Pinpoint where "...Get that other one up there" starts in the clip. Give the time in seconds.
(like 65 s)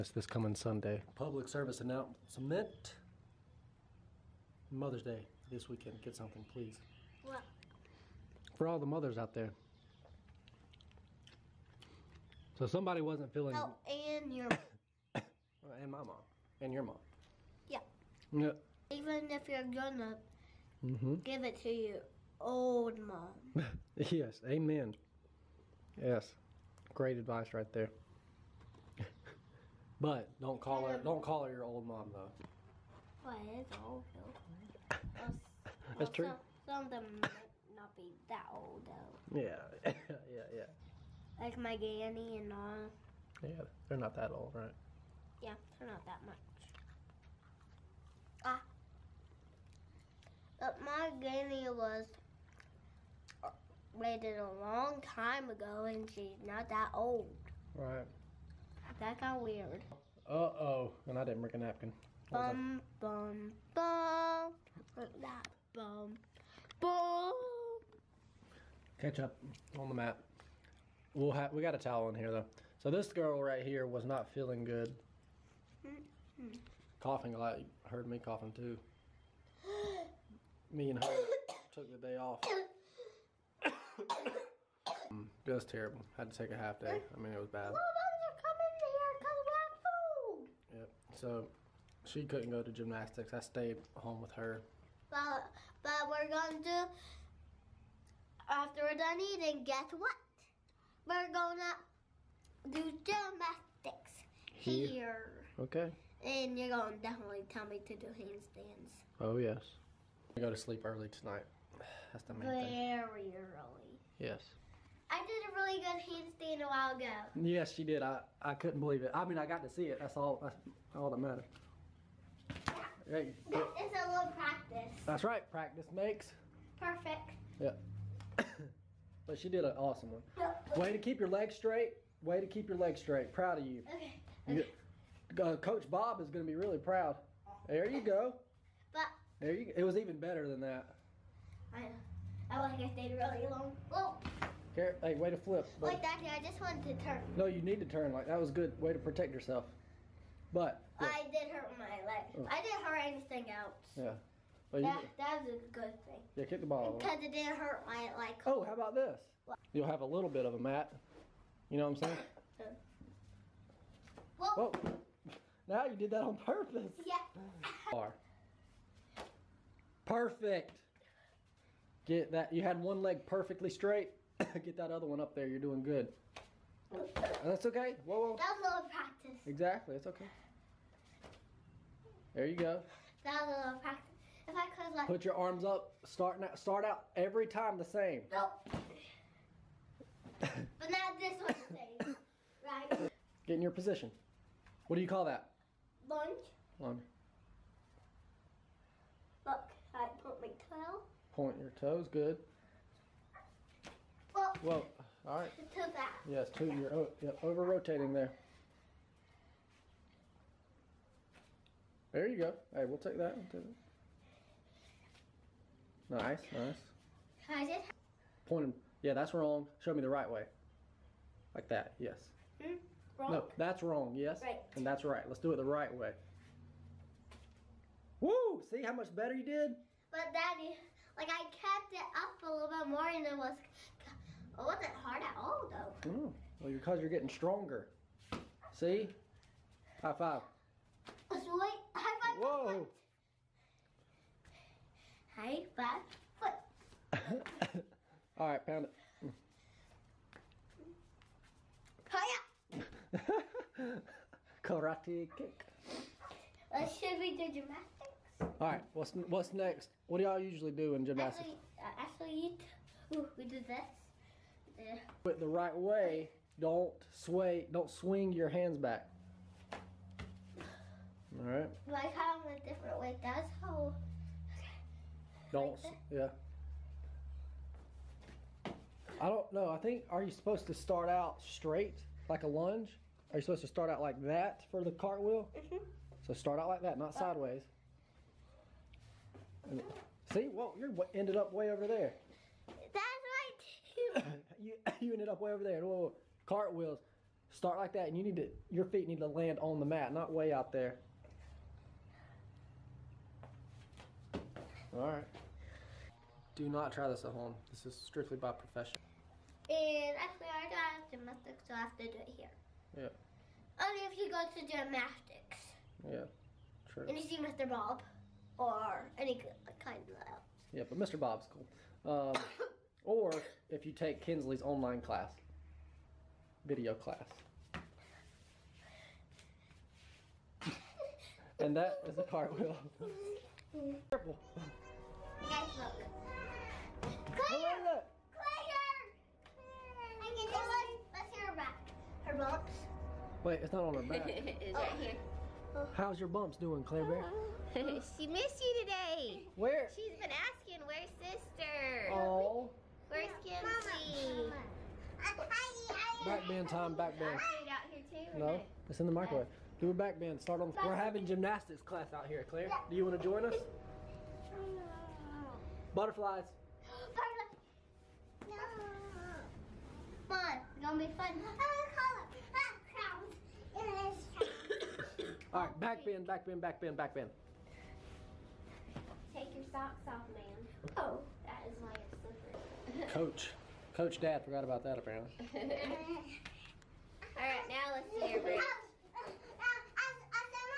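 174 s.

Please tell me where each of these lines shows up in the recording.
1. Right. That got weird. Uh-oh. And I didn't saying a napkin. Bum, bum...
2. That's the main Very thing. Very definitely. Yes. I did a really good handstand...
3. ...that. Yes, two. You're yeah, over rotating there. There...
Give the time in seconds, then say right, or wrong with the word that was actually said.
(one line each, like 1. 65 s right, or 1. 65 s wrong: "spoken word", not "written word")
1. 57 s wrong: "bring", not "saying"
2. 112 s wrong: "early", not "definitely"
3. 205 s right.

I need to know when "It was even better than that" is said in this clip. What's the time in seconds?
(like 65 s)
139 s.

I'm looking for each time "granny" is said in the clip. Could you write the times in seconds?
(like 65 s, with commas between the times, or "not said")
41 s, 51 s.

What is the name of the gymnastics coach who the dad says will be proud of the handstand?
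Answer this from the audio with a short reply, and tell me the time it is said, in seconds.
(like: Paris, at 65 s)
Coach Bob, at 135 s.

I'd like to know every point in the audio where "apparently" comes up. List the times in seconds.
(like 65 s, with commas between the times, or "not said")
384 s.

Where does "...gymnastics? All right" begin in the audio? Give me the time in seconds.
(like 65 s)
257 s.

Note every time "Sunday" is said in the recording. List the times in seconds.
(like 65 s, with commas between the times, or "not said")
0 s.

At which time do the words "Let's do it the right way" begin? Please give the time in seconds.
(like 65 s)
225 s.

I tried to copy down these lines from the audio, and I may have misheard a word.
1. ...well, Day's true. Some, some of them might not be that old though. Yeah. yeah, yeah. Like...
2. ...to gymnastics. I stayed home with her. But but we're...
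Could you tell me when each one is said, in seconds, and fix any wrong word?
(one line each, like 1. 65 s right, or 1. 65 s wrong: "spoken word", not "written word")
1. 34 s wrong: "That", not "Day"
2. 92 s right.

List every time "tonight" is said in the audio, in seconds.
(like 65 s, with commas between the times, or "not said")
111 s.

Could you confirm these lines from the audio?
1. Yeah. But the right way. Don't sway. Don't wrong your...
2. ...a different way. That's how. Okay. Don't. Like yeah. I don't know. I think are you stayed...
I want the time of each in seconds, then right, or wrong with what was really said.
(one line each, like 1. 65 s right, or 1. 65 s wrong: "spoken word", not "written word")
1. 264 s wrong: "swing", not "wrong"
2. 272 s wrong: "supposed", not "stayed".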